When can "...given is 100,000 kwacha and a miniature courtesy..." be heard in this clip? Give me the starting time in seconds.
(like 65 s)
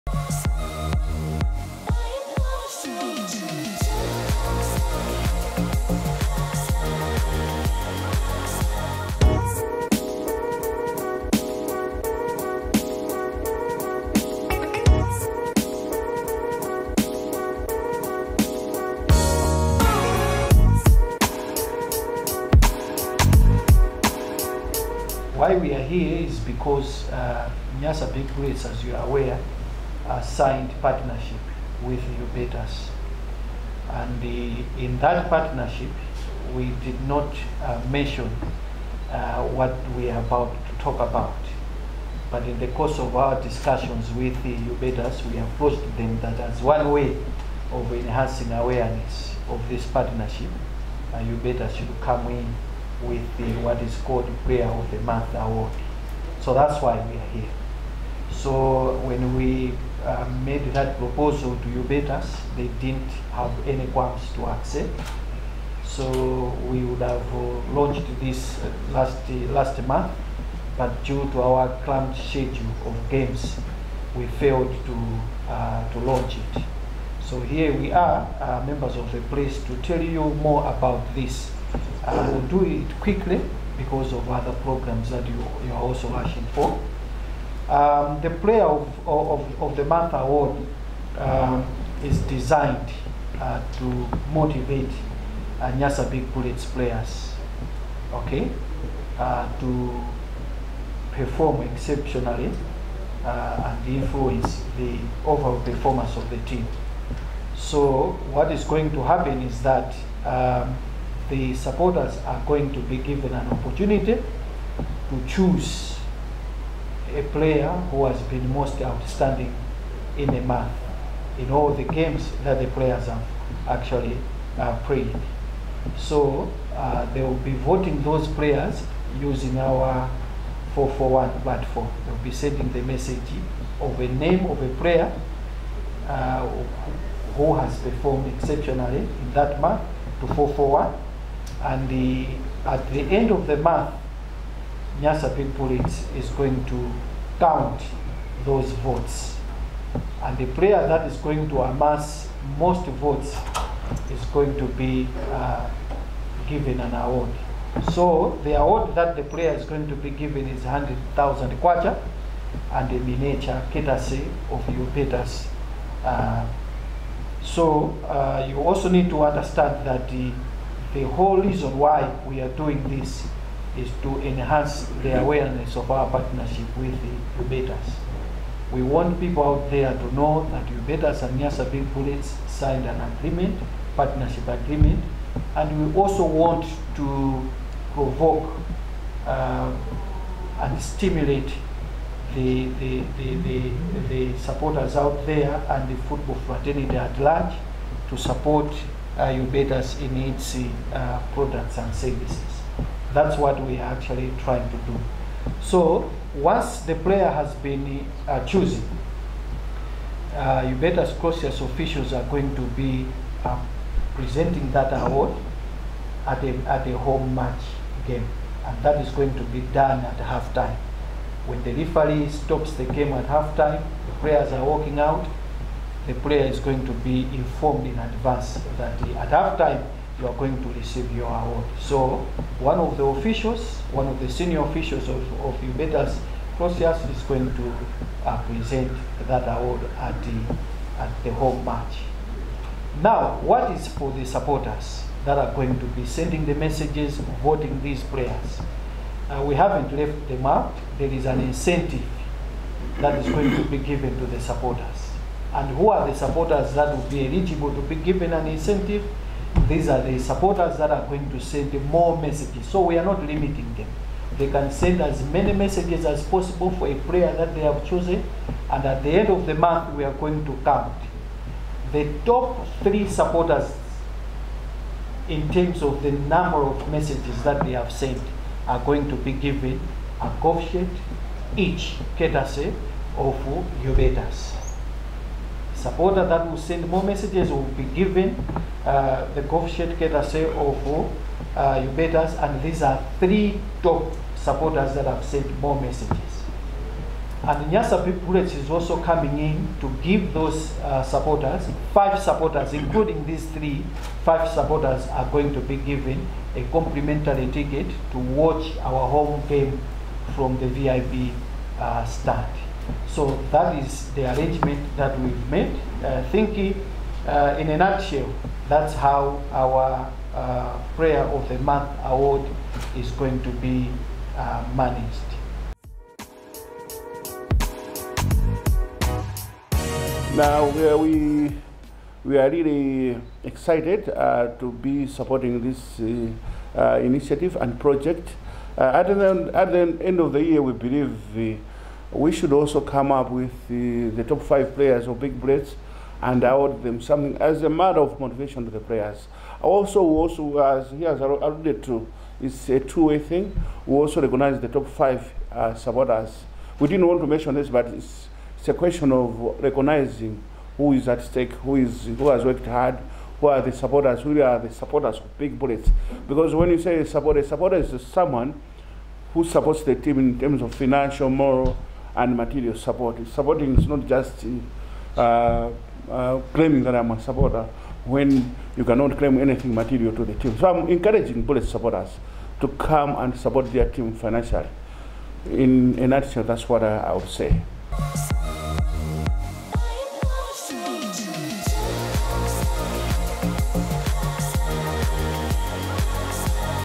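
160 s.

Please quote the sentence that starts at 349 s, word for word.
Also, also as he has alluded to, it's a two-way thing.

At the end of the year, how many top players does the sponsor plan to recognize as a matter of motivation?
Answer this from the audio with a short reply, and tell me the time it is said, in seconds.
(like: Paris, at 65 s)
5, at 344 s.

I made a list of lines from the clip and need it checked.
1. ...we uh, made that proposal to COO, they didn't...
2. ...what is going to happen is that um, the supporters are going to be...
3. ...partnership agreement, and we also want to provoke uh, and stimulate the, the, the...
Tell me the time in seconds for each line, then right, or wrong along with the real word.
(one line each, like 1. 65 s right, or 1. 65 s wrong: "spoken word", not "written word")
1. 59 s wrong: "Hubertus", not "COO"
2. 108 s right
3. 183 s right.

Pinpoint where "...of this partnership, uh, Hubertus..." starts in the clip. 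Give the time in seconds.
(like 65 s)
49 s.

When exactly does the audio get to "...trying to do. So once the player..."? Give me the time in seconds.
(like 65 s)
204 s.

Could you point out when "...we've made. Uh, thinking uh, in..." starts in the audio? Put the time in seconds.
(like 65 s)
315 s.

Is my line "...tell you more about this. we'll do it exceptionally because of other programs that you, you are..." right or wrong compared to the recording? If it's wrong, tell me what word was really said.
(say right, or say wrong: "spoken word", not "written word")
wrong: "quickly", not "exceptionally".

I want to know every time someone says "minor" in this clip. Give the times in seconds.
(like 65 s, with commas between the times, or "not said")
not said.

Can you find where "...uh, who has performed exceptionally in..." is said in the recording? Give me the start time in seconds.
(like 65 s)
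136 s.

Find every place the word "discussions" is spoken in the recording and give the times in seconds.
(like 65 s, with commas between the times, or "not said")
43 s.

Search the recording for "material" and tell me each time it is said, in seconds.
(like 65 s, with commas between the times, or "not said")
372 s, 379 s.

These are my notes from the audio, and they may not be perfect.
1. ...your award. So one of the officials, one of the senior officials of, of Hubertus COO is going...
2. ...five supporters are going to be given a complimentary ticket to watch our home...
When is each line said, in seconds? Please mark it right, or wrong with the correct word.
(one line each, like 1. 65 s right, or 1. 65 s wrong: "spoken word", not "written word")
1. 231 s wrong: "Clausius", not "COO"
2. 304 s right.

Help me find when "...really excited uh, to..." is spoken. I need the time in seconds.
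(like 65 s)
332 s.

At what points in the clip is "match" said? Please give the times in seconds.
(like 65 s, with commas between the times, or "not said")
217 s, 241 s.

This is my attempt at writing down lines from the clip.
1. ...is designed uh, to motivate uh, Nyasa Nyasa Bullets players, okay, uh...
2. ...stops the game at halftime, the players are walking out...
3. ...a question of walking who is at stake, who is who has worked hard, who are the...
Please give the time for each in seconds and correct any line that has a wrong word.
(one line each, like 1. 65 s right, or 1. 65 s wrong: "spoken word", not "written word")
1. 92 s wrong: "Big", not "Nyasa"
2. 222 s right
3. 358 s wrong: "recognizing", not "walking".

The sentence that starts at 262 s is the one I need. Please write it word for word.
So we are not limiting them.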